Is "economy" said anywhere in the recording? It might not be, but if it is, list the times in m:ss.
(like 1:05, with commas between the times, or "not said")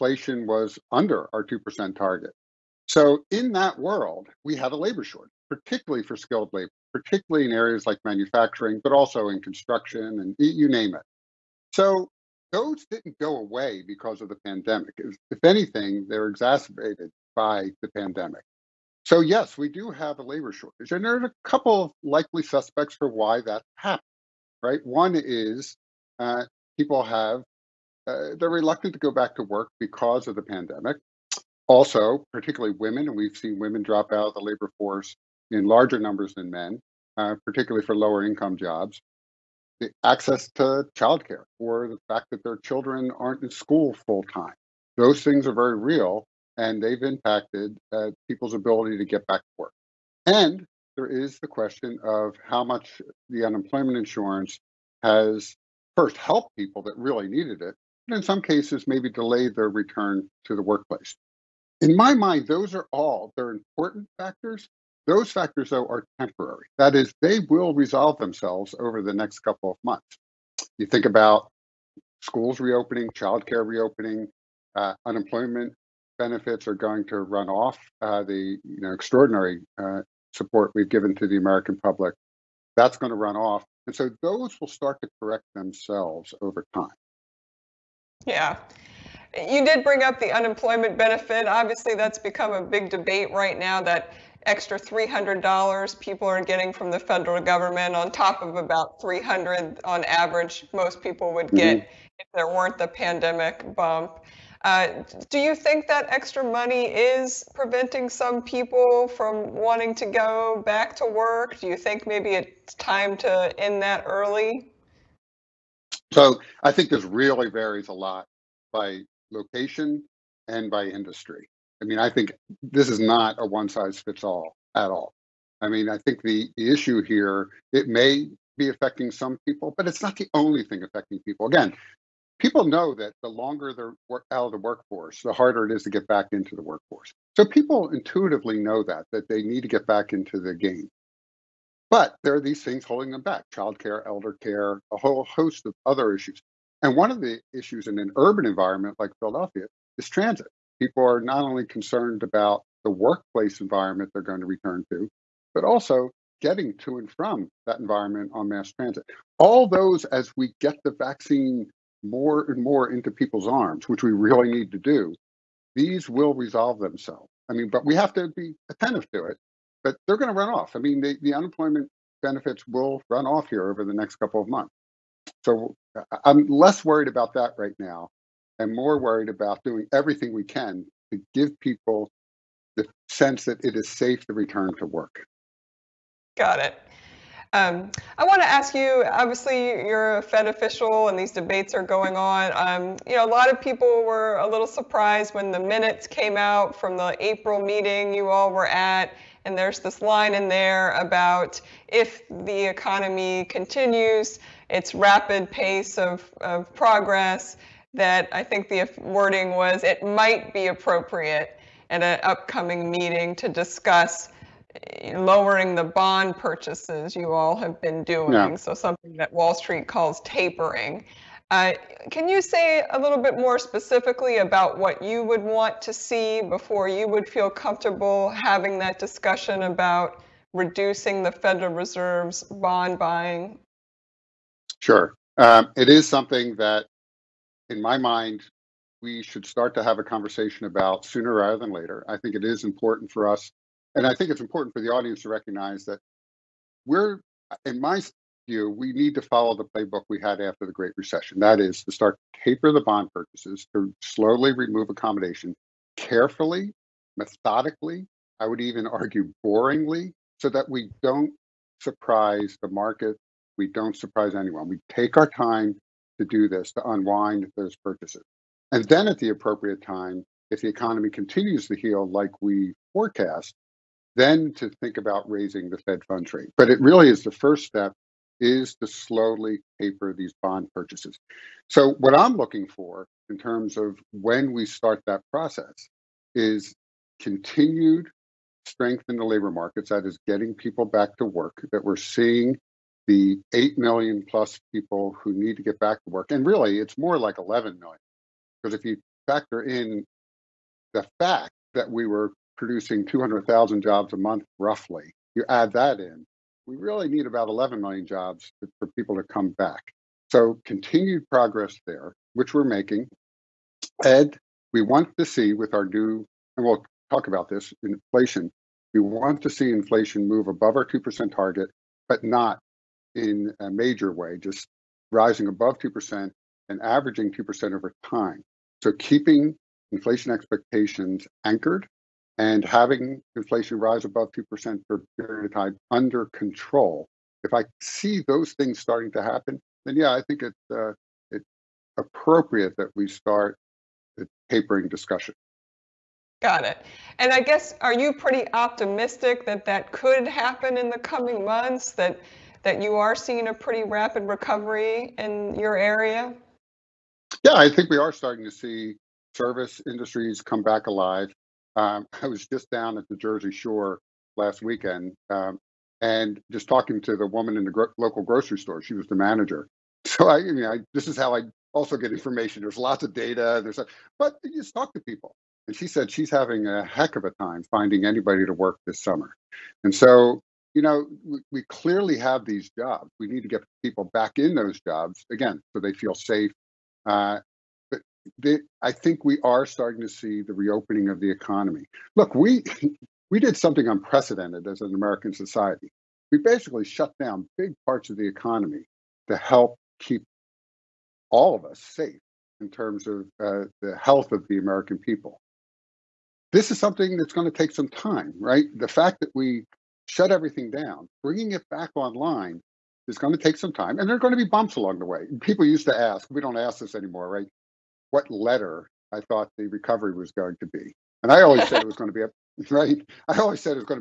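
3:22, 4:30, 6:31, 6:38.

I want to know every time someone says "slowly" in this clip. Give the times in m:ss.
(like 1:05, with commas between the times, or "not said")
4:14, 4:38.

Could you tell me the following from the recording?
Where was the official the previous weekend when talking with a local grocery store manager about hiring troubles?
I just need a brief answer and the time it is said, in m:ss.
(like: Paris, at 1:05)
the Jersey Shore, at 6:03.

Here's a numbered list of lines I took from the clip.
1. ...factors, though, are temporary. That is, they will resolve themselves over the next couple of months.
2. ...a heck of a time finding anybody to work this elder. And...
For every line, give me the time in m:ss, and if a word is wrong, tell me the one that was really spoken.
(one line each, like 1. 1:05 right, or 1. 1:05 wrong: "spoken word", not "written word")
1. 1:05 right
2. 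6:16 wrong: "summer", not "elder".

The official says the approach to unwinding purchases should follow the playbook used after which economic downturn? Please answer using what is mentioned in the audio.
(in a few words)
the Great Recession.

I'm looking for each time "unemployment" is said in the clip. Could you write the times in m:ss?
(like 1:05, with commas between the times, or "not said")
0:53, 1:15, 1:30, 2:51.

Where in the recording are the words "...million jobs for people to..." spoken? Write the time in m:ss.
5:07.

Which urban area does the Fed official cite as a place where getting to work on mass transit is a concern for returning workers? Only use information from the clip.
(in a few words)
Philadelphia.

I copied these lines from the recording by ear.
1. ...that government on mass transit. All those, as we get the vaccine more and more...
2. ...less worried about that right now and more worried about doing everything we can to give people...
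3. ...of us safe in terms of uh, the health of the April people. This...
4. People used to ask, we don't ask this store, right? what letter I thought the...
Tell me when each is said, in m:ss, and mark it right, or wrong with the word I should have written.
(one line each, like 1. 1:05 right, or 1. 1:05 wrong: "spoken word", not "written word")
1. 2:37 wrong: "environment", not "government"
2. 2:56 right
3. 6:41 wrong: "American", not "April"
4. 6:55 wrong: "anymore", not "store".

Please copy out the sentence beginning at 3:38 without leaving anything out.
so something that Wall Street calls tapering.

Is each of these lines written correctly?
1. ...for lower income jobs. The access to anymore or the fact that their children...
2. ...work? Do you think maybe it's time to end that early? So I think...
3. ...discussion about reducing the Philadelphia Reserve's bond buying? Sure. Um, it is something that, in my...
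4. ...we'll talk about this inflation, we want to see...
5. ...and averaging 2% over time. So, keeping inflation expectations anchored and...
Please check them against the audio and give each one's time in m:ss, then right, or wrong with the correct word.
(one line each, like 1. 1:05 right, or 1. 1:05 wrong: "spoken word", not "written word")
1. 0:37 wrong: "childcare", not "anymore"
2. 1:51 right
3. 3:48 wrong: "Federal", not "Philadelphia"
4. 5:16 right
5. 5:26 right.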